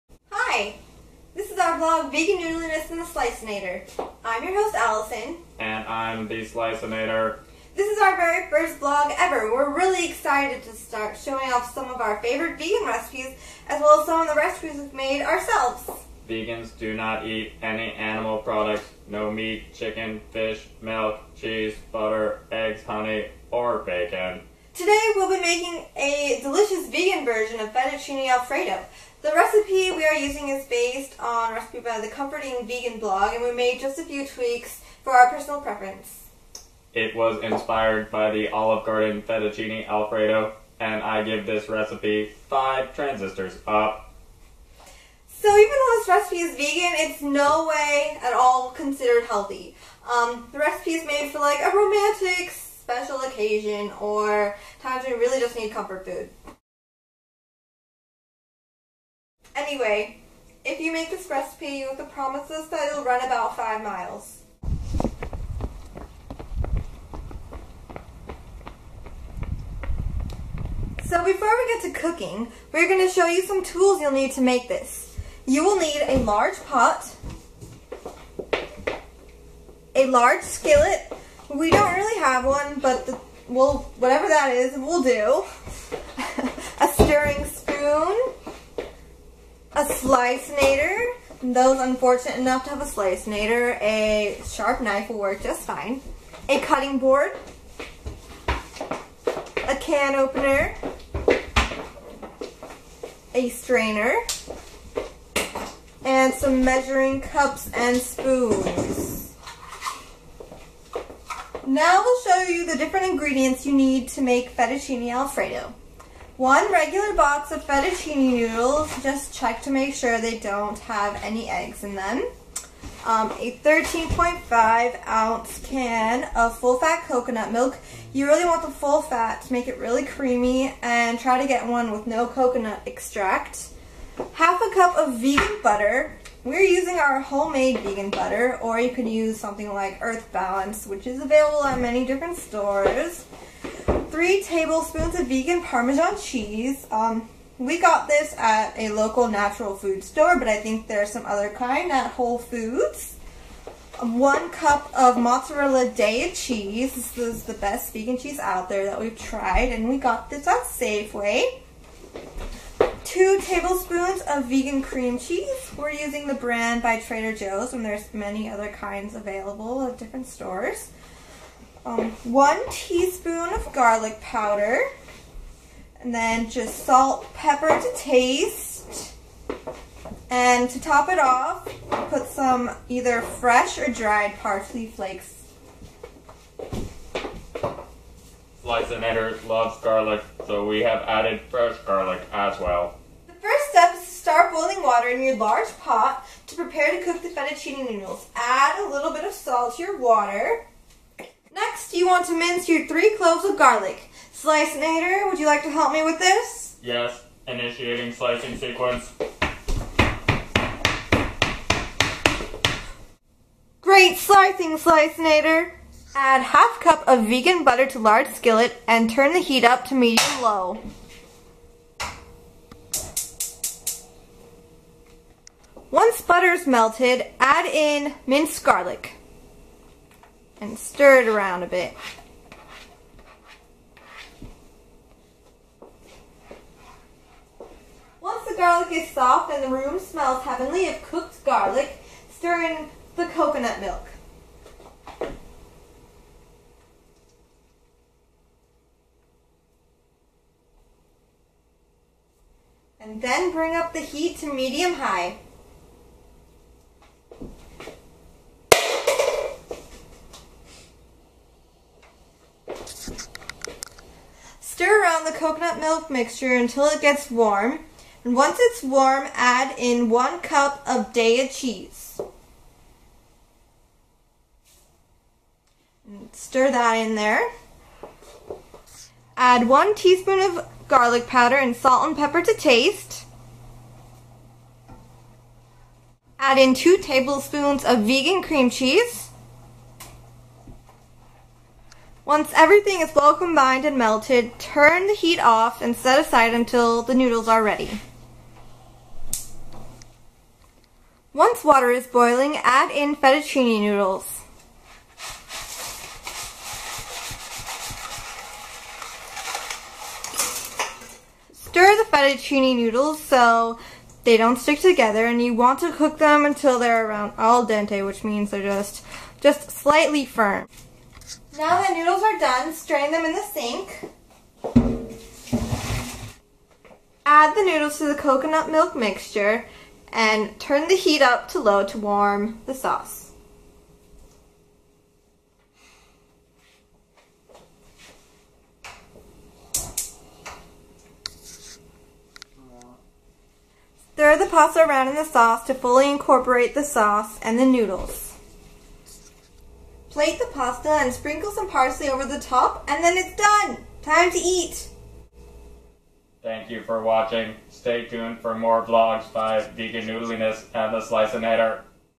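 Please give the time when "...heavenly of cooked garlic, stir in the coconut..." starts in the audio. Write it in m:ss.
4:00.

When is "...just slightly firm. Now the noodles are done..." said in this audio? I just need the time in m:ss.
5:19.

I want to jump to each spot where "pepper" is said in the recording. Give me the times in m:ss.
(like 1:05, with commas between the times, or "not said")
2:57, 4:42.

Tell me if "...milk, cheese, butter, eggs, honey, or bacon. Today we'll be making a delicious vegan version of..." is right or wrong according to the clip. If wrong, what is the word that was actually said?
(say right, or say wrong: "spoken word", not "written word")
right.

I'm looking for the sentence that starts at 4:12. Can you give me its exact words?
And then bring up the heat to medium high.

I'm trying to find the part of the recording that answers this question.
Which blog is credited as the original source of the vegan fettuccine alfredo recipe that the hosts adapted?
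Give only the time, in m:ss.
0:32.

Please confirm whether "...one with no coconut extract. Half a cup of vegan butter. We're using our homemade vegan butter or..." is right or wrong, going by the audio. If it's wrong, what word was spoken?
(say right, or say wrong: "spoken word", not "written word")
right.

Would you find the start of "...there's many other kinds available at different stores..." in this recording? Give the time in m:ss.
2:47.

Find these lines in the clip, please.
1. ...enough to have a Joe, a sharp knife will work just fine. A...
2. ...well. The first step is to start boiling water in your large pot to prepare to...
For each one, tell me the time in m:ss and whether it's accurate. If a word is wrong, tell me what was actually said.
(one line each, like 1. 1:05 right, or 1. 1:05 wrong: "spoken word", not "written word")
1. 1:32 wrong: "Slicinator", not "Joe"
2. 3:12 right.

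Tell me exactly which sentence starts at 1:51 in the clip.
Now we'll show you the different ingredients you need to make fettuccine alfredo.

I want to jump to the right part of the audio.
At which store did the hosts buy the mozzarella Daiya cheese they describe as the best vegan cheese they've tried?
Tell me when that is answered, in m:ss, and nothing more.
2:40.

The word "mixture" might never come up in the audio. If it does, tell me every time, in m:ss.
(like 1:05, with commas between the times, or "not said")
4:26, 5:28.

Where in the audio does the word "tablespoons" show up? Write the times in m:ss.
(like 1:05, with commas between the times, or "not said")
2:24, 2:43, 4:46.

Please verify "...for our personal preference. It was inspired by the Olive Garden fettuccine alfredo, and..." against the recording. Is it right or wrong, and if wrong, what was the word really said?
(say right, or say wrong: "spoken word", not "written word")
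right.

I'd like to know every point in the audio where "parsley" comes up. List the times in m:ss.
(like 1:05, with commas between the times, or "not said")
3:04, 5:51.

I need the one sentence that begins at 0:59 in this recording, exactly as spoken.
Anyway, if you make this recipe with the promises that it'll run about 5 miles.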